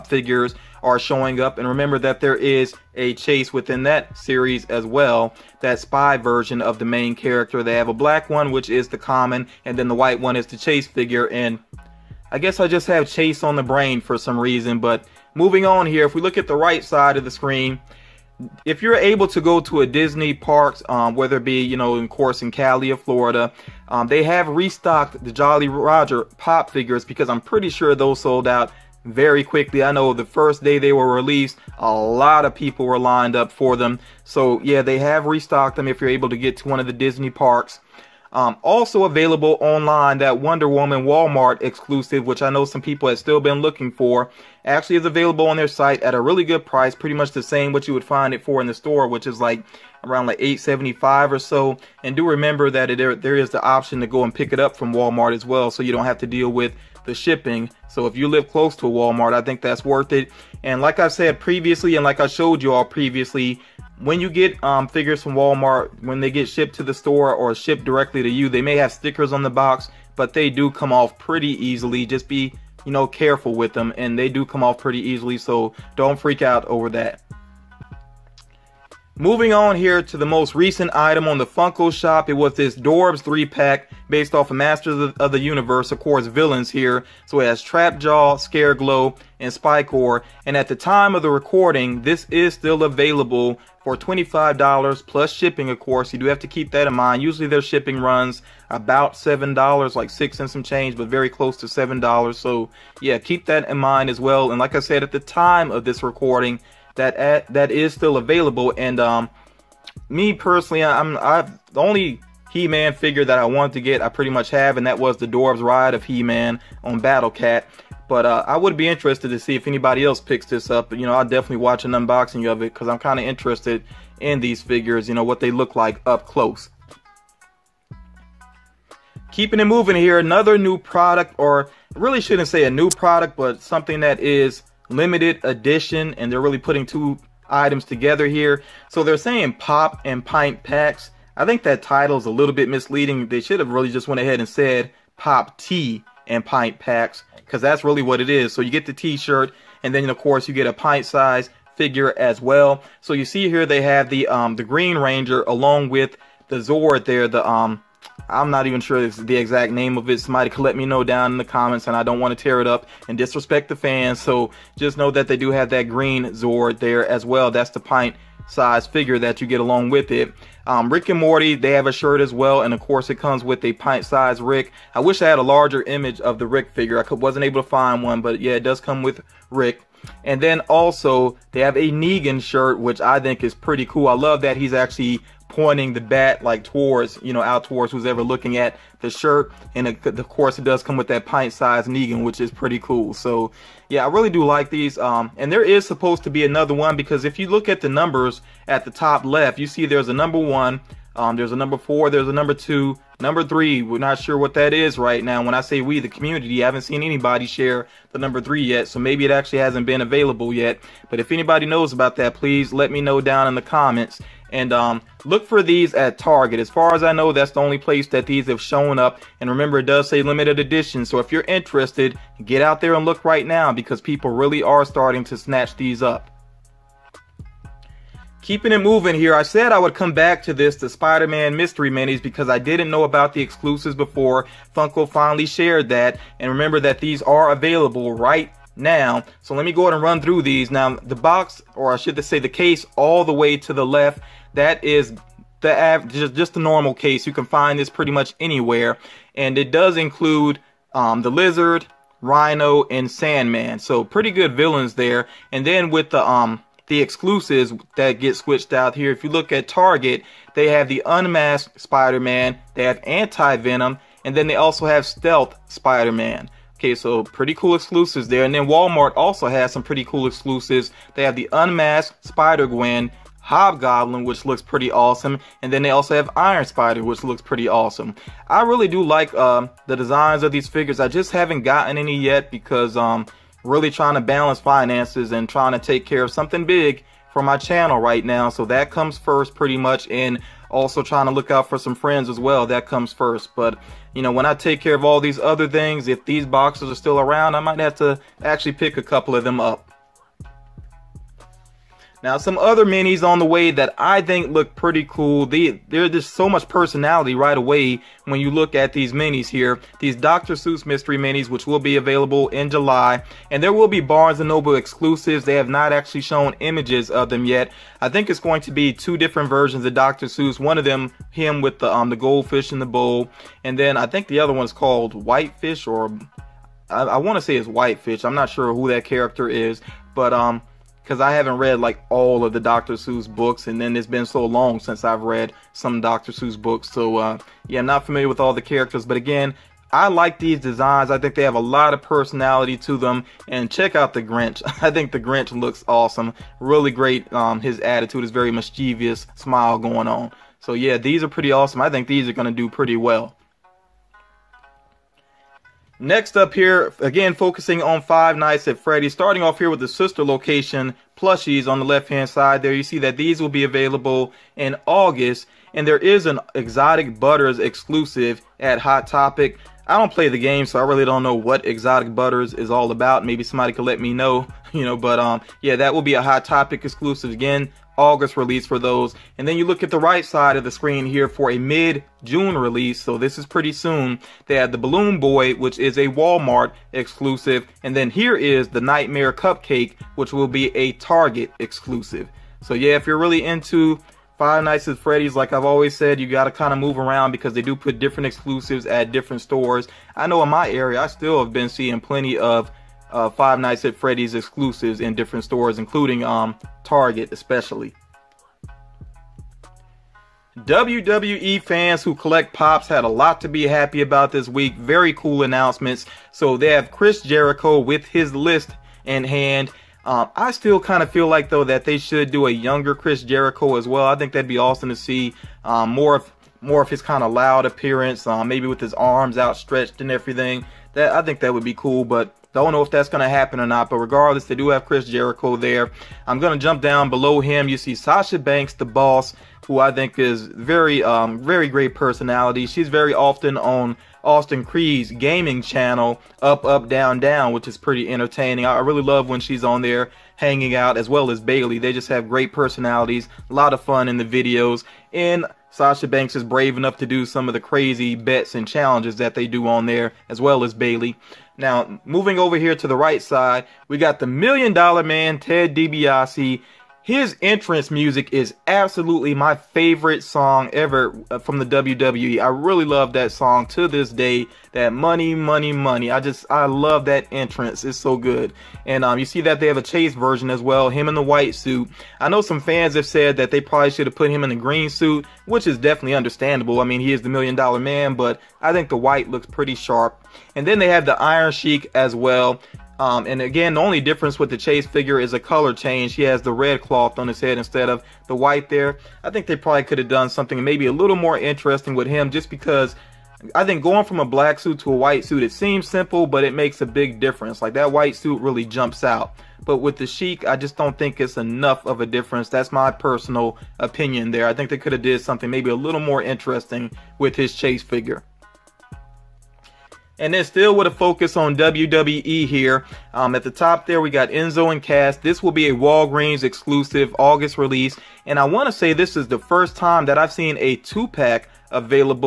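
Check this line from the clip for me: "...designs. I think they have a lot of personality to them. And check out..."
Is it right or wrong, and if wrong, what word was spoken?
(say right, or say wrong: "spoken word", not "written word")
right.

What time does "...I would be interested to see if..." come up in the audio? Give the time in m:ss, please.
1:58.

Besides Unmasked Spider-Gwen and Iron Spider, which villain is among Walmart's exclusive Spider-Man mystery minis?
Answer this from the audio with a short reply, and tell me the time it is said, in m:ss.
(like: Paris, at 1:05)
Hobgoblin, at 4:33.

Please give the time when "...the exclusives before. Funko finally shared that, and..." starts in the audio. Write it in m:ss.
3:53.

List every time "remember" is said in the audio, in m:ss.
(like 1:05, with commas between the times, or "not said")
0:01, 0:52, 3:39, 3:56.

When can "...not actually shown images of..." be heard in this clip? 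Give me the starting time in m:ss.
5:15.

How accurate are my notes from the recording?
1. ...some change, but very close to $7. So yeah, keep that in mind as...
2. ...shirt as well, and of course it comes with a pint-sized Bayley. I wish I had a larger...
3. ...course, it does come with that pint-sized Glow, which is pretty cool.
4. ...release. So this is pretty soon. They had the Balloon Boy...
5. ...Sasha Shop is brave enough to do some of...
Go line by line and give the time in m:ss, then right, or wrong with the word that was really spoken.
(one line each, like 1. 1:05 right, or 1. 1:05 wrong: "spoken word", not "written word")
1. 1:40 right
2. 2:51 wrong: "Rick", not "Bayley"
3. 3:10 wrong: "Negan", not "Glow"
4. 6:22 right
5. 7:35 wrong: "Banks", not "Shop".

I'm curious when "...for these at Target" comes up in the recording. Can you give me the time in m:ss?
3:35.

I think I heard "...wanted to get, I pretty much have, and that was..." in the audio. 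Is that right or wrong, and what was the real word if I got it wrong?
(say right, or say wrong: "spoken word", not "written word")
right.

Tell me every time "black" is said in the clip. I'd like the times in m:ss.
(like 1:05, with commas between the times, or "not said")
0:07, 8:24.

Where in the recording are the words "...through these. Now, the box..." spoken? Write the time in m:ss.
4:00.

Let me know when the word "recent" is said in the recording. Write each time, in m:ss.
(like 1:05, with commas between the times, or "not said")
1:20.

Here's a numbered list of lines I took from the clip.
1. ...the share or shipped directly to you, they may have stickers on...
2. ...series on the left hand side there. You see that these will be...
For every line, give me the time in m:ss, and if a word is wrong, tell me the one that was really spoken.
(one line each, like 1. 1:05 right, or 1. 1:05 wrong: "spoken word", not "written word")
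1. 1:06 wrong: "store", not "share"
2. 6:01 wrong: "plushies", not "series".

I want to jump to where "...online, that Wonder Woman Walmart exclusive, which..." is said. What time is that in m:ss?
0:39.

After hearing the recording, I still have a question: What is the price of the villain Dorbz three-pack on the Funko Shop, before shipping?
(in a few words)
$25.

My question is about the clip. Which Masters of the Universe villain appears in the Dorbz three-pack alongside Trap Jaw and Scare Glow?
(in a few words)
Spikor.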